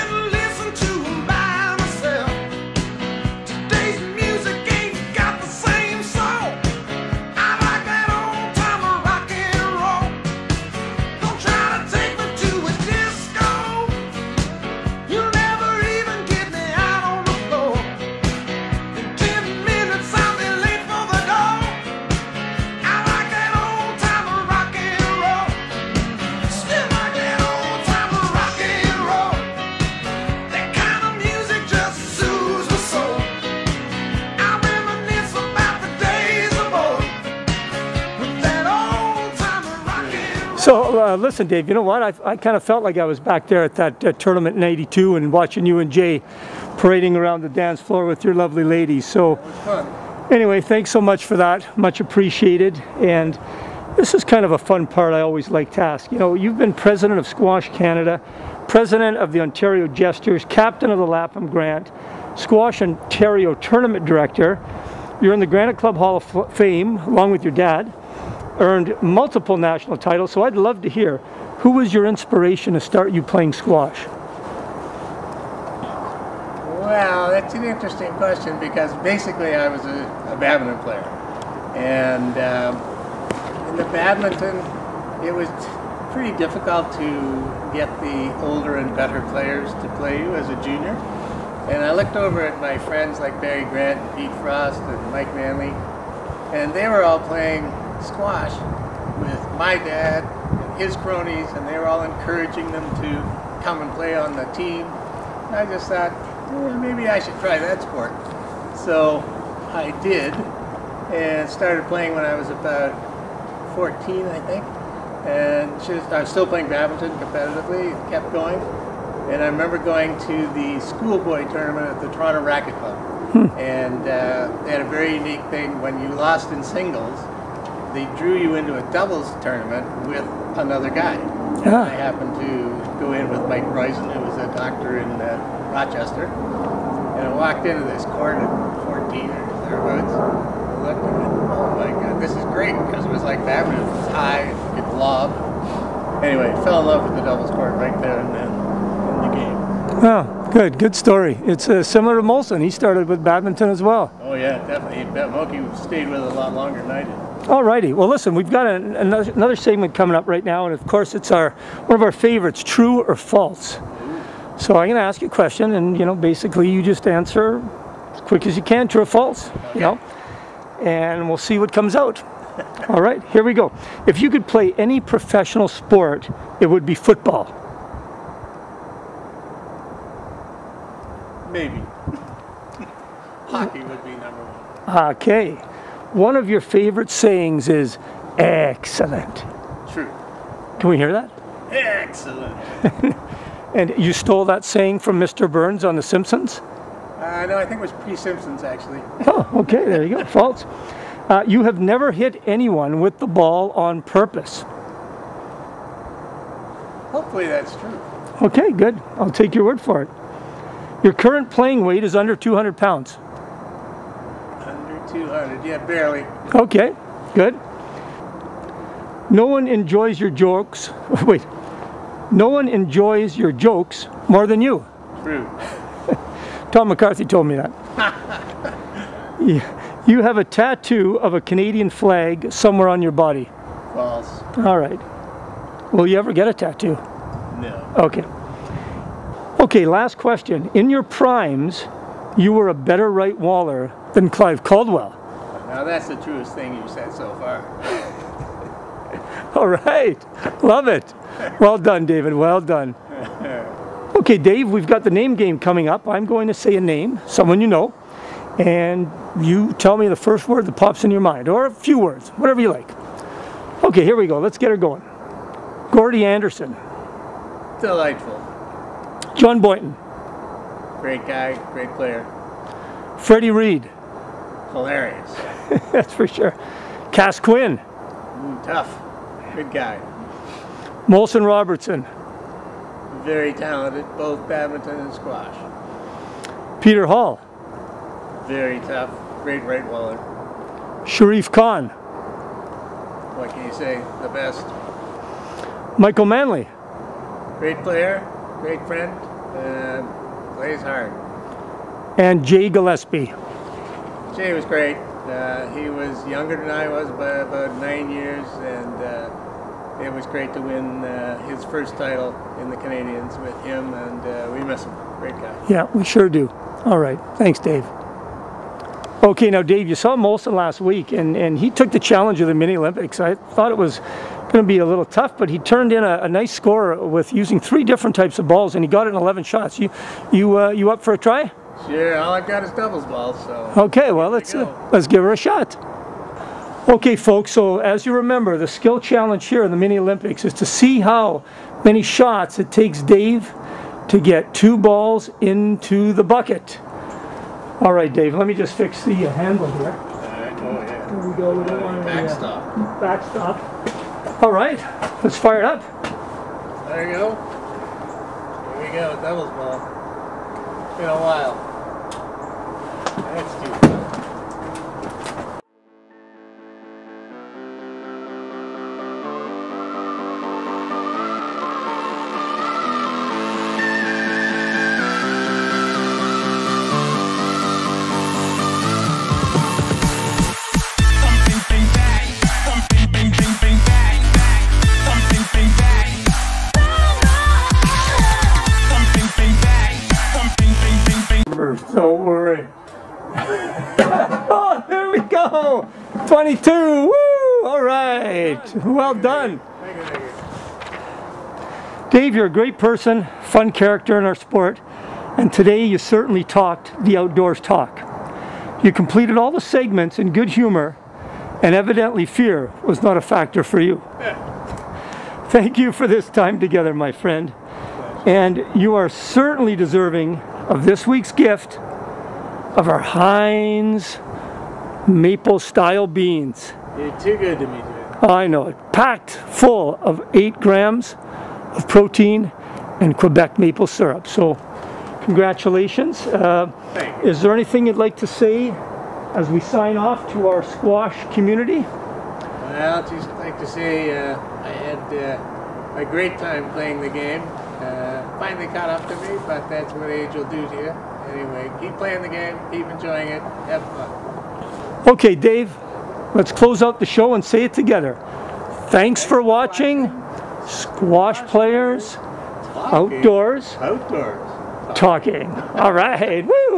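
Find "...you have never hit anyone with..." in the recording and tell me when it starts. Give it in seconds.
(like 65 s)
201 s.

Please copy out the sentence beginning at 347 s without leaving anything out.
All right, Dave, let me just fix the uh, handle here.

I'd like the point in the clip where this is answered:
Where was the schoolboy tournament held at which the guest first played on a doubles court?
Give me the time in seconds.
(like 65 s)
122 s.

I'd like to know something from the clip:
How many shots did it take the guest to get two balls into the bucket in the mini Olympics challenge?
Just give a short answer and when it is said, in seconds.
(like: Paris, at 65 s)
22, at 396 s.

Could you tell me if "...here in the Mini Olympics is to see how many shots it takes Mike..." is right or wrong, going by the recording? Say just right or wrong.
wrong.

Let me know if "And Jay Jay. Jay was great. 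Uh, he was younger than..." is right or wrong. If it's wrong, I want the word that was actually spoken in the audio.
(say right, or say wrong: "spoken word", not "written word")
wrong: "Gillespie", not "Jay".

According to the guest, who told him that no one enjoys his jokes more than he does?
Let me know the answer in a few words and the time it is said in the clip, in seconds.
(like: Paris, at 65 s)
Tom McCarthy, at 226 s.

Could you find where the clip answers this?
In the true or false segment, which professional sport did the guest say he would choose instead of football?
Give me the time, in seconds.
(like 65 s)
183 s.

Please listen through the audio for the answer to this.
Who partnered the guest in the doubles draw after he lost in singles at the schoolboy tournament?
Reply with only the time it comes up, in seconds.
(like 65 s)
133 s.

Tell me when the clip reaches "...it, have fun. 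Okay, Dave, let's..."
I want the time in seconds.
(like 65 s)
453 s.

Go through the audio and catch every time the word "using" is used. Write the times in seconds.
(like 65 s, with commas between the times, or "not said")
327 s.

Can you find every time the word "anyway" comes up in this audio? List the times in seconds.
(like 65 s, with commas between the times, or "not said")
50 s, 146 s, 451 s.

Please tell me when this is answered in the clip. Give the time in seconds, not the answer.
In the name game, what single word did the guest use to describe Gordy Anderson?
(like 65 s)
267 s.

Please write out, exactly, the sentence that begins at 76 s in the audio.
Well, that's an interesting question because basically I was a, a badminton player.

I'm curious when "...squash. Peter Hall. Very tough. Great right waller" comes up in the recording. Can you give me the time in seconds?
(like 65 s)
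285 s.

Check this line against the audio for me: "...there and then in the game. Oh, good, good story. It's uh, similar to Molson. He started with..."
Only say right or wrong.
right.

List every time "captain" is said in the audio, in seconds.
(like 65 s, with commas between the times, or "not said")
60 s.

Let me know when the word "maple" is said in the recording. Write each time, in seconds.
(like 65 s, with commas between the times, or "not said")
425 s, 433 s.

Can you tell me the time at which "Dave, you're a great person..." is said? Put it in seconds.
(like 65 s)
402 s.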